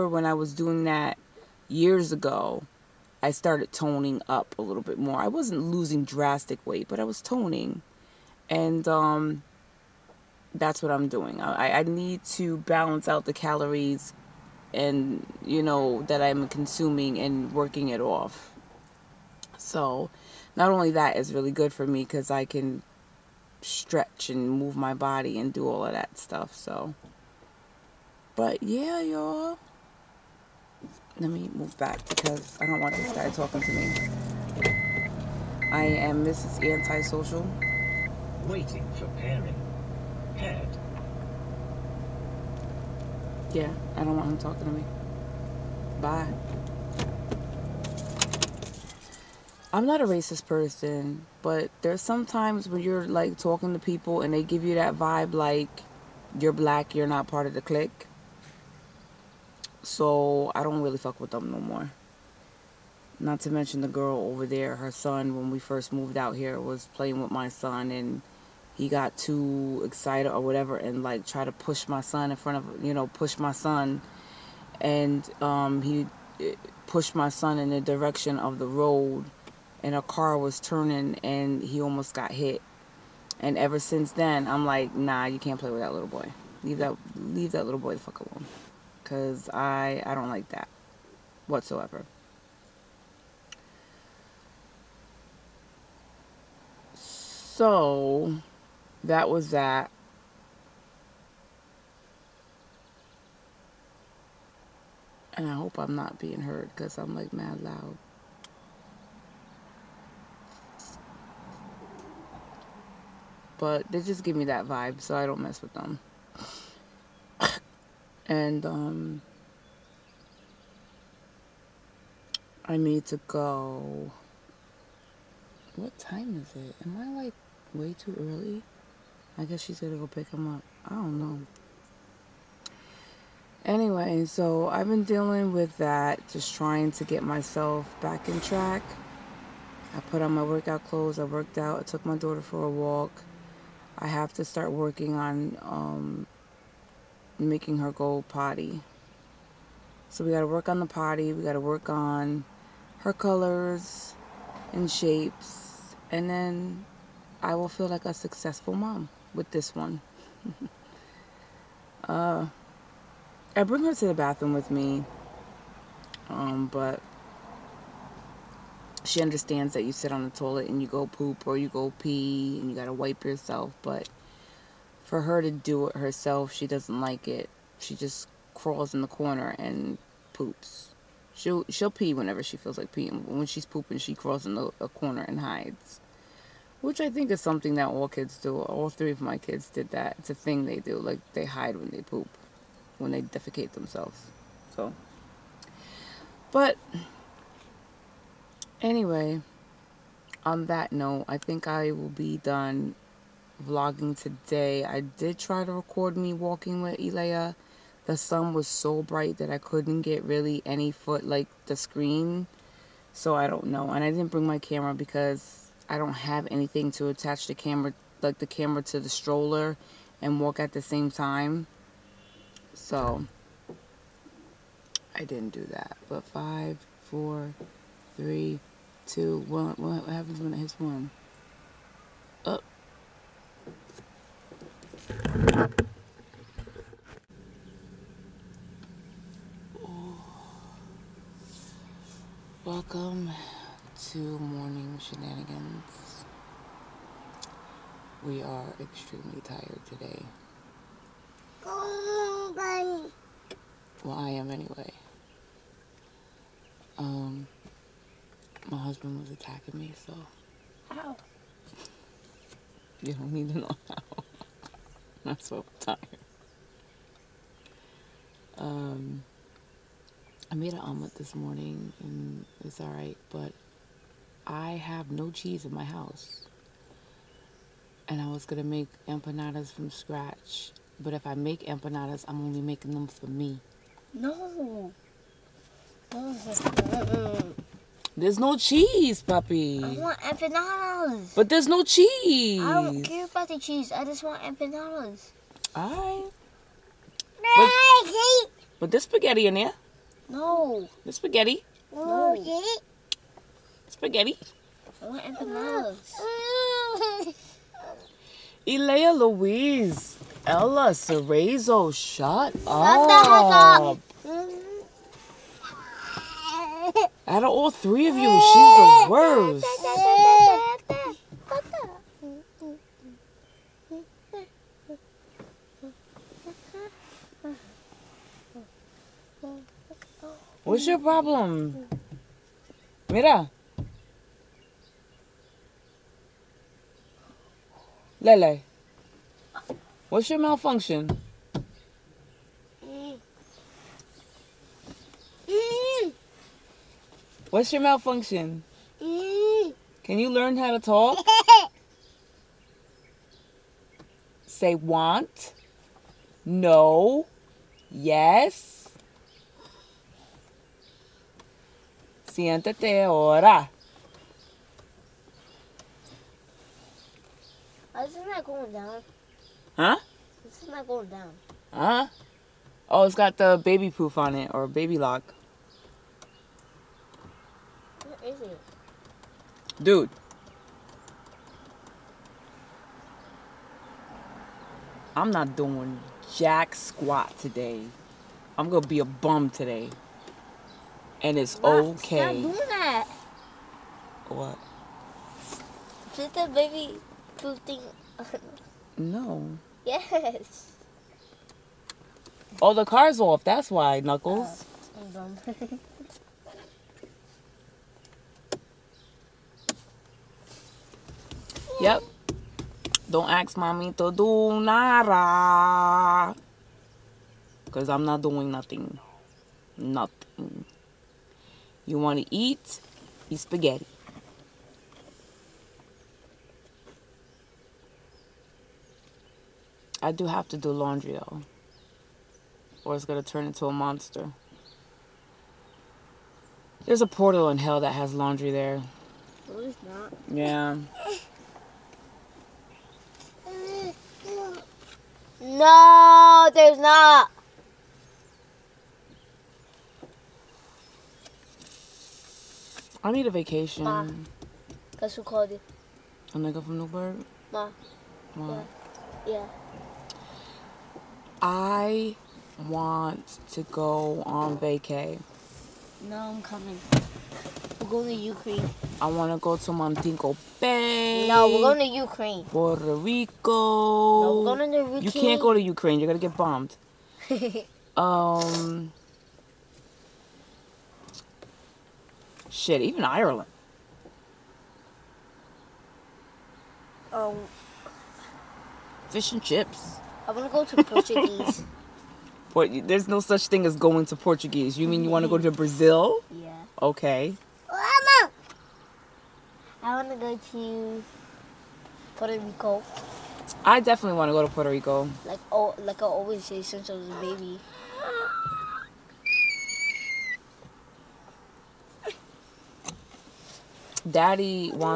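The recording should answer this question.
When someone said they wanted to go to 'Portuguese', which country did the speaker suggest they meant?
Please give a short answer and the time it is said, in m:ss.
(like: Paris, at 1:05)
Brazil, at 8:15.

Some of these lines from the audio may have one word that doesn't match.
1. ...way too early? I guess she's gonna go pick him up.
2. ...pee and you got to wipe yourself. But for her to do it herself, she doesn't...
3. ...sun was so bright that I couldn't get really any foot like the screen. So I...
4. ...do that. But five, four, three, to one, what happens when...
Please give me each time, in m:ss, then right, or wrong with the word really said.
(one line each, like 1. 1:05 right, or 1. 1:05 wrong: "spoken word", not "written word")
1. 2:07 right
2. 2:51 right
3. 3:28 right
4. 3:45 right.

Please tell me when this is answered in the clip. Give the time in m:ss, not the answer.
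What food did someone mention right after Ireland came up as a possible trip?
8:09.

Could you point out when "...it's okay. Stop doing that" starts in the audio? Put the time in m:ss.
6:31.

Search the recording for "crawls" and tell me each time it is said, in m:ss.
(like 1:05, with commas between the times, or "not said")
2:58, 3:04.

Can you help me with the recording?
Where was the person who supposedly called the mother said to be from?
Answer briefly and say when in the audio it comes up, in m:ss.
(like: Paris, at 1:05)
Newburgh, at 7:36.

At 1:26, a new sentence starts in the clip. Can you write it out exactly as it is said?
Leave that, leave that little boy the fuck alone.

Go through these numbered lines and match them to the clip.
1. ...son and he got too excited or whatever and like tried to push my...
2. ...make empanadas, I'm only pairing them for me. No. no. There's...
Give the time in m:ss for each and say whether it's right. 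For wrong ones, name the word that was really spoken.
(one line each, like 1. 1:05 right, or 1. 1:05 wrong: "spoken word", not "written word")
1. 1:07 right
2. 4:41 wrong: "making", not "pairing".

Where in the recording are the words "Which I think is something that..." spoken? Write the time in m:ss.
3:06.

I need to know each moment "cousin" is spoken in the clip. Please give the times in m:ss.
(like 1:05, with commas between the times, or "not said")
not said.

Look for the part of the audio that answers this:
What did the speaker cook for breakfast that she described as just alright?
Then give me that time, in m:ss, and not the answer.
4:30.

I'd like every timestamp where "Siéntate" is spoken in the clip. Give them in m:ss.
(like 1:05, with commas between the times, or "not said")
6:02.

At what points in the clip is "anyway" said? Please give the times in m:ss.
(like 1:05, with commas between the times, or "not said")
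2:13, 3:18, 4:14.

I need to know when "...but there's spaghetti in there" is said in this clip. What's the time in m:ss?
4:58.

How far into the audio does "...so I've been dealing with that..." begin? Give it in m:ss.
2:14.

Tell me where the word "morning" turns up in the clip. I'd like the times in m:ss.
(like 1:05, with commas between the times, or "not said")
4:04, 4:31.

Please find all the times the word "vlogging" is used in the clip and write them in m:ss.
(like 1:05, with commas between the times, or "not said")
3:23.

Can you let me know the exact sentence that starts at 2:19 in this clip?
I put on my workout clothes, I worked out, I took my daughter for a walk.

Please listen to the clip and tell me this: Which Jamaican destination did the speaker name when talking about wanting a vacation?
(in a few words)
Montego Bay.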